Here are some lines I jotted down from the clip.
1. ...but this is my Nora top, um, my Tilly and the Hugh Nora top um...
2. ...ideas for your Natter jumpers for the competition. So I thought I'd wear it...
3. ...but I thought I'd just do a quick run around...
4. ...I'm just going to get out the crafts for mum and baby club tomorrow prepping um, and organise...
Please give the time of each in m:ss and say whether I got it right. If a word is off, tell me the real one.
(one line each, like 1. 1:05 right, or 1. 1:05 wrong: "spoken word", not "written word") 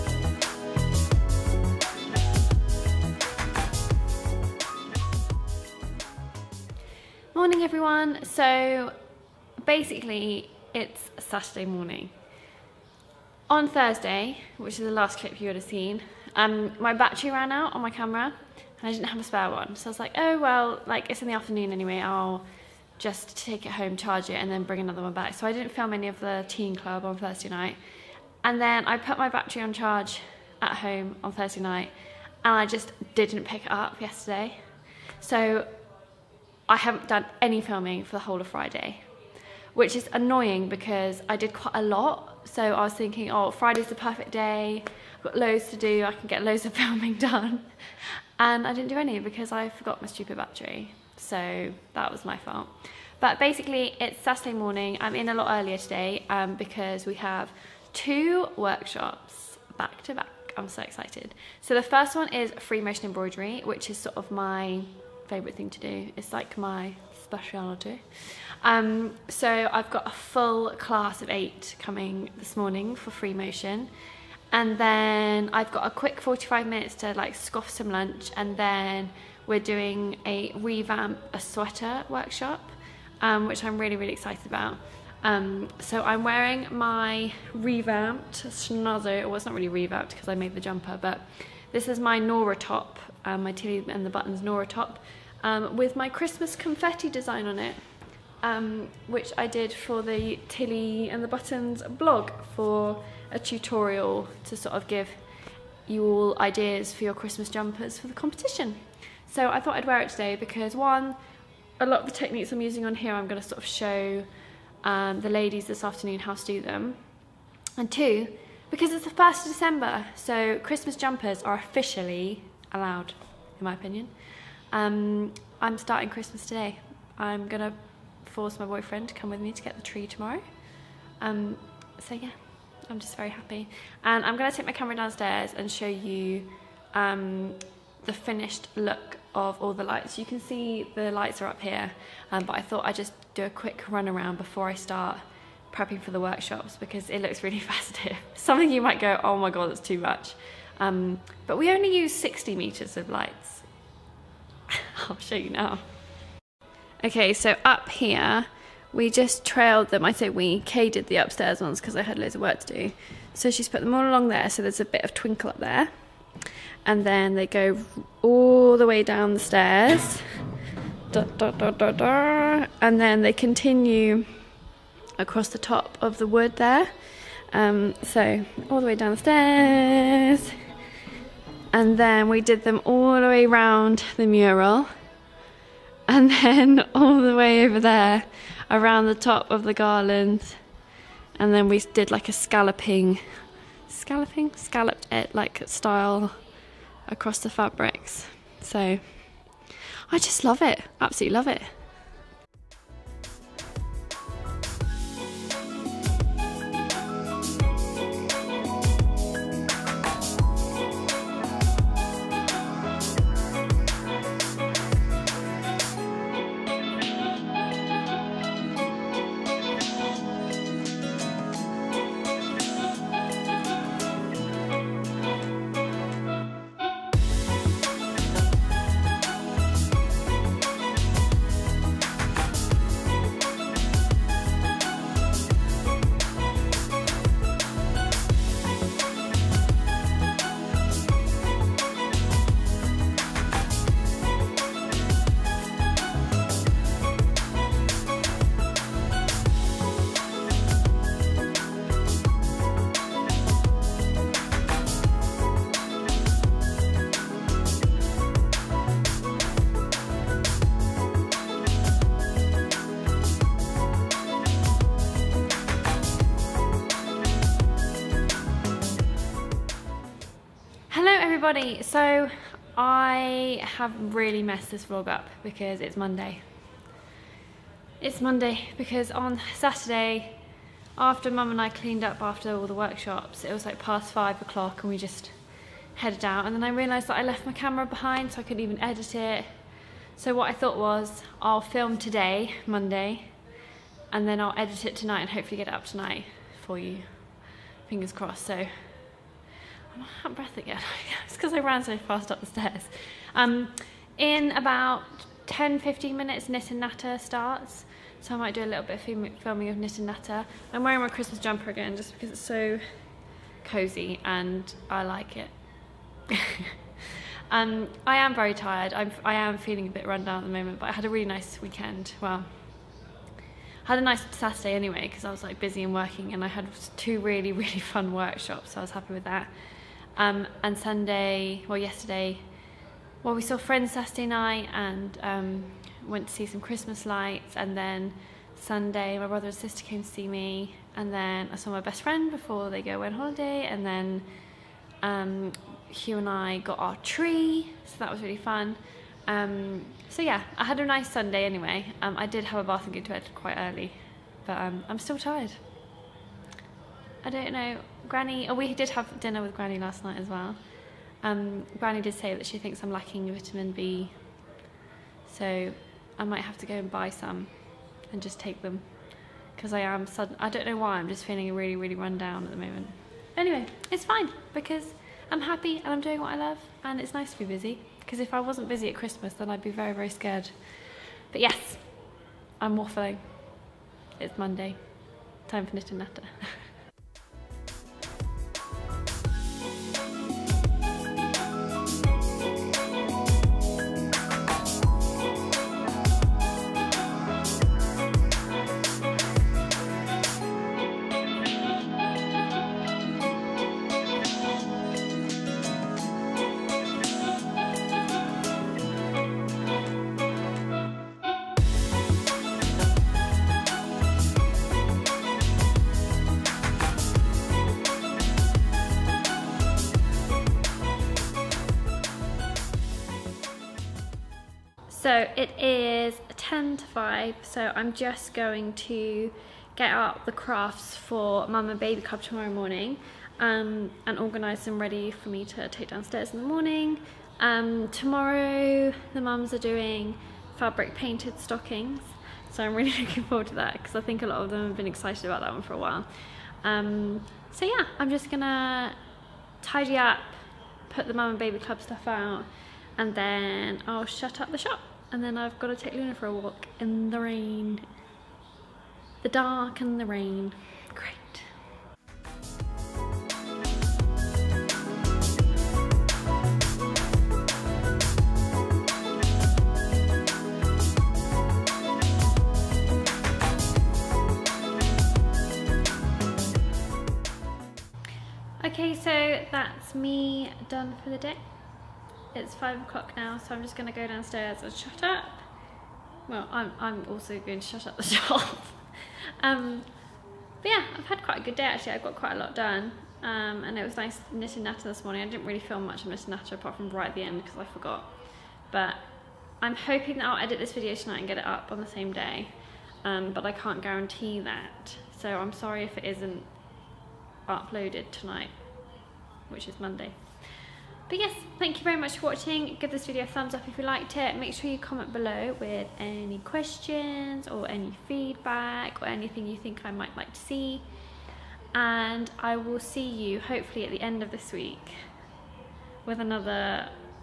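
1. 1:30 wrong: "Buttons", not "Hugh"
2. 1:46 wrong: "Christmas", not "Natter"
3. 2:22 right
4. 7:07 wrong: "morning", not "prepping".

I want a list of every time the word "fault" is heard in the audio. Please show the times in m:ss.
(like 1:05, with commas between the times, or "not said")
0:52.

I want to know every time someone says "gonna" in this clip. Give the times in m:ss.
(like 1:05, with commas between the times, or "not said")
2:07, 2:14, 7:28, 8:03.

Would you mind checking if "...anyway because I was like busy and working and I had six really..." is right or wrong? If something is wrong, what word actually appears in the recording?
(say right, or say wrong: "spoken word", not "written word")
wrong: "two", not "six".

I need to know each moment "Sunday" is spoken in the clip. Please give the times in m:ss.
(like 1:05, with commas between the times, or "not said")
5:30, 5:38, 5:51.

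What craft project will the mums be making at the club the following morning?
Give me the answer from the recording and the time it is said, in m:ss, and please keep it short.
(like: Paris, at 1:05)
Fabric painted stockings, at 7:20.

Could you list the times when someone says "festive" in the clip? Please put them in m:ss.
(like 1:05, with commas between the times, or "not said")
2:27.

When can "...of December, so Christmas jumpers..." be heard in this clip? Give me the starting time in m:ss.
1:59.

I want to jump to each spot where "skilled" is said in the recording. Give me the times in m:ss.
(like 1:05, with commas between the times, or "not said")
not said.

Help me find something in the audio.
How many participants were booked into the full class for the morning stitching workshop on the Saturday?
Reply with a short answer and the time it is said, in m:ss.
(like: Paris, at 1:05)
8, at 1:11.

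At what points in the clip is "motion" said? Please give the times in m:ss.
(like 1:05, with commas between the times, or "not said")
1:02, 1:13.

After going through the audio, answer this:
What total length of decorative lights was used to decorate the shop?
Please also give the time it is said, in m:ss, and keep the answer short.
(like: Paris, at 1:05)
60 meters, at 2:32.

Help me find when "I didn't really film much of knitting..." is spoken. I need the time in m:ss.
8:15.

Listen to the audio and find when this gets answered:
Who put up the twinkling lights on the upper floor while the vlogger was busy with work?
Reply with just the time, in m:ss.
2:40.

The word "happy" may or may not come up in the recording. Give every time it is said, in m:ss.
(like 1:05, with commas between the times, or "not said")
2:13, 5:28, 6:15.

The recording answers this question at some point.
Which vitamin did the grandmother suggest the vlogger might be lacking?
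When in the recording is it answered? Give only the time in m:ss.
6:03.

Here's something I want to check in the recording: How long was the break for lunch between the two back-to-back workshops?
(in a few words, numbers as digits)
45 minutes.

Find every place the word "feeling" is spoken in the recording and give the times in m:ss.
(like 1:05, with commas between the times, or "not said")
5:19, 6:11.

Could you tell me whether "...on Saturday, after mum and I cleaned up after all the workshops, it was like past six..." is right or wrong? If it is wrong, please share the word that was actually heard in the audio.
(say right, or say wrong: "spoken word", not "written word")
wrong: "five", not "six".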